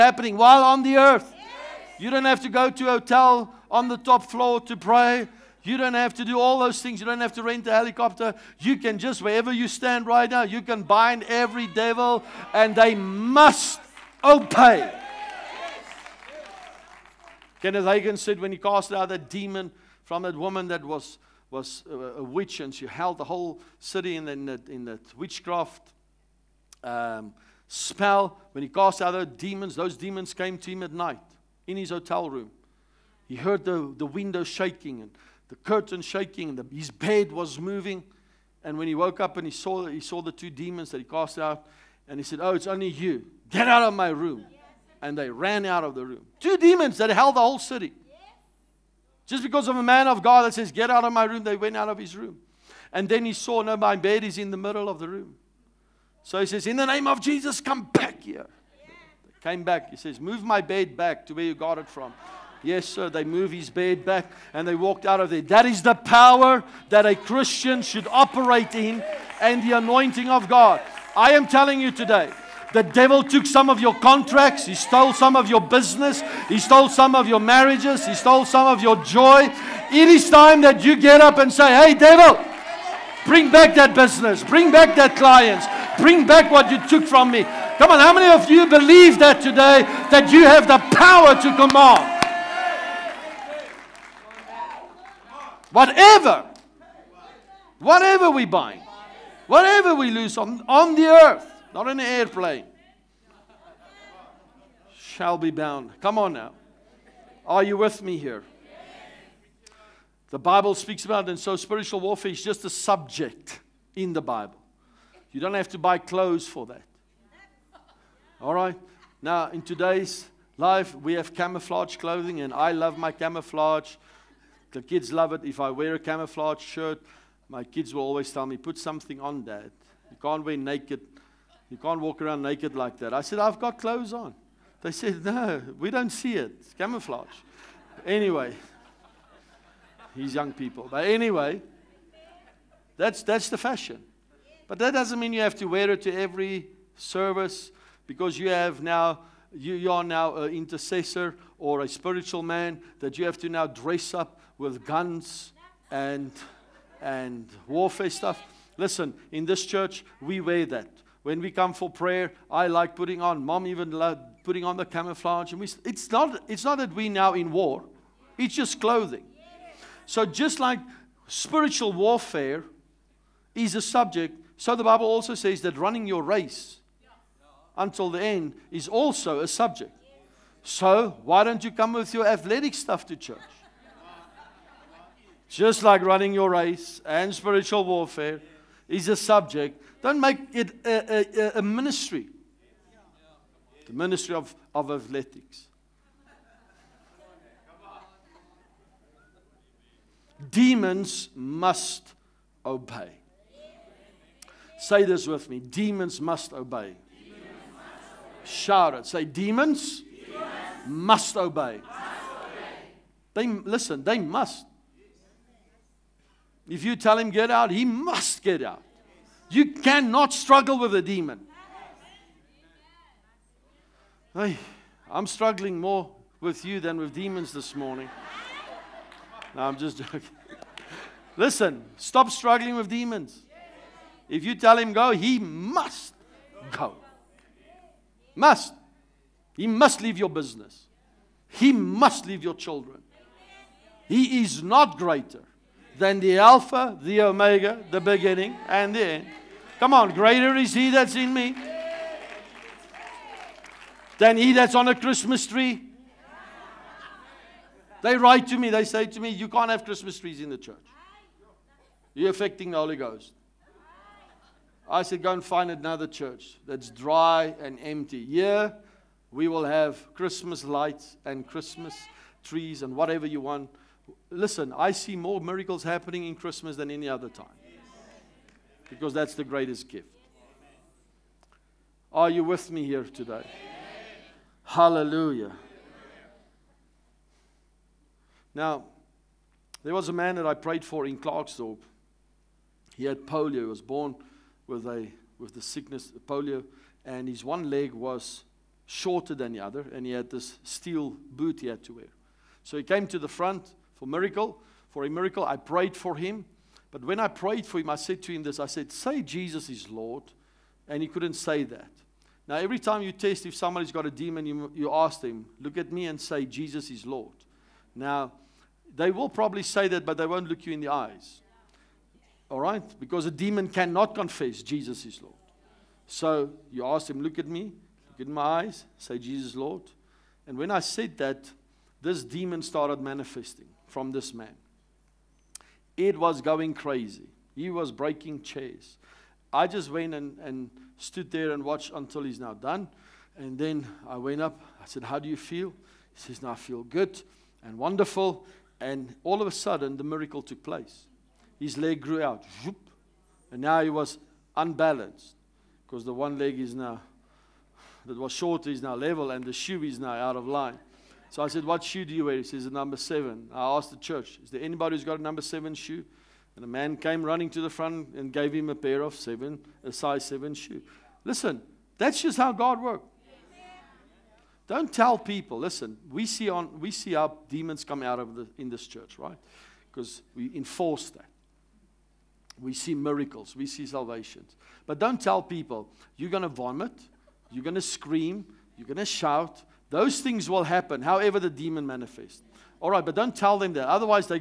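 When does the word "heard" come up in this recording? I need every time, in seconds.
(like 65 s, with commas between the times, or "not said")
33 s.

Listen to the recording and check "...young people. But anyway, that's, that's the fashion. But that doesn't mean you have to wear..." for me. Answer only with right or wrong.
right.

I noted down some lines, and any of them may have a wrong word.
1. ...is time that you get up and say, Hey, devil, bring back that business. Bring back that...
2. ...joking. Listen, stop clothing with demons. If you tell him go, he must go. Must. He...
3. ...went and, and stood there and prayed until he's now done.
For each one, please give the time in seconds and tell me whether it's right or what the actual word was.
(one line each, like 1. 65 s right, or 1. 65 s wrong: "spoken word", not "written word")
1. 80 s right
2. 229 s wrong: "struggling", not "clothing"
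3. 339 s wrong: "watched", not "prayed".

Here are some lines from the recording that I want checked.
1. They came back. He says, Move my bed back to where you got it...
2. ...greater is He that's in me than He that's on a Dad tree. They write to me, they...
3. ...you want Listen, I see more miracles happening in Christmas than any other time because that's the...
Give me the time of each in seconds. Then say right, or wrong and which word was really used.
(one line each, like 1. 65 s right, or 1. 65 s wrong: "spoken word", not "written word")
1. 59 s right
2. 250 s wrong: "Christmas", not "Dad"
3. 273 s right.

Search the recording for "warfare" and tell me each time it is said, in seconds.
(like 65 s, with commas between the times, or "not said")
111 s, 157 s, 171 s, 187 s.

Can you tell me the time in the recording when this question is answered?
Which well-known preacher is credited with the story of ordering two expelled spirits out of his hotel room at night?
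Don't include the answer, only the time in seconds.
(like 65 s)
17 s.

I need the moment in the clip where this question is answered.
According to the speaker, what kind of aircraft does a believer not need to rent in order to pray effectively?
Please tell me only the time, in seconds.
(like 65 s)
7 s.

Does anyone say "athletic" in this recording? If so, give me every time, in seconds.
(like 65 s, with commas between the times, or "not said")
182 s, 194 s.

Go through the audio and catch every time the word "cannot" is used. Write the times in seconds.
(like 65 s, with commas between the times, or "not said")
219 s, 323 s.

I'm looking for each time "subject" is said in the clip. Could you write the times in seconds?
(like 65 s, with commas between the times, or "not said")
112 s, 173 s, 179 s, 189 s.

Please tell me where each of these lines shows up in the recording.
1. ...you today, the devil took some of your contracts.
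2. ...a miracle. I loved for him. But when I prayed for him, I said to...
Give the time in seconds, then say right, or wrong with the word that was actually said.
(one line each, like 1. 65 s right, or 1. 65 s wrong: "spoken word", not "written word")
1. 71 s right
2. 305 s wrong: "prayed", not "loved".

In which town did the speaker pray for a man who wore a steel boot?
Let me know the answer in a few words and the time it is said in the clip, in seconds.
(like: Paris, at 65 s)
Klerksdorp, at 291 s.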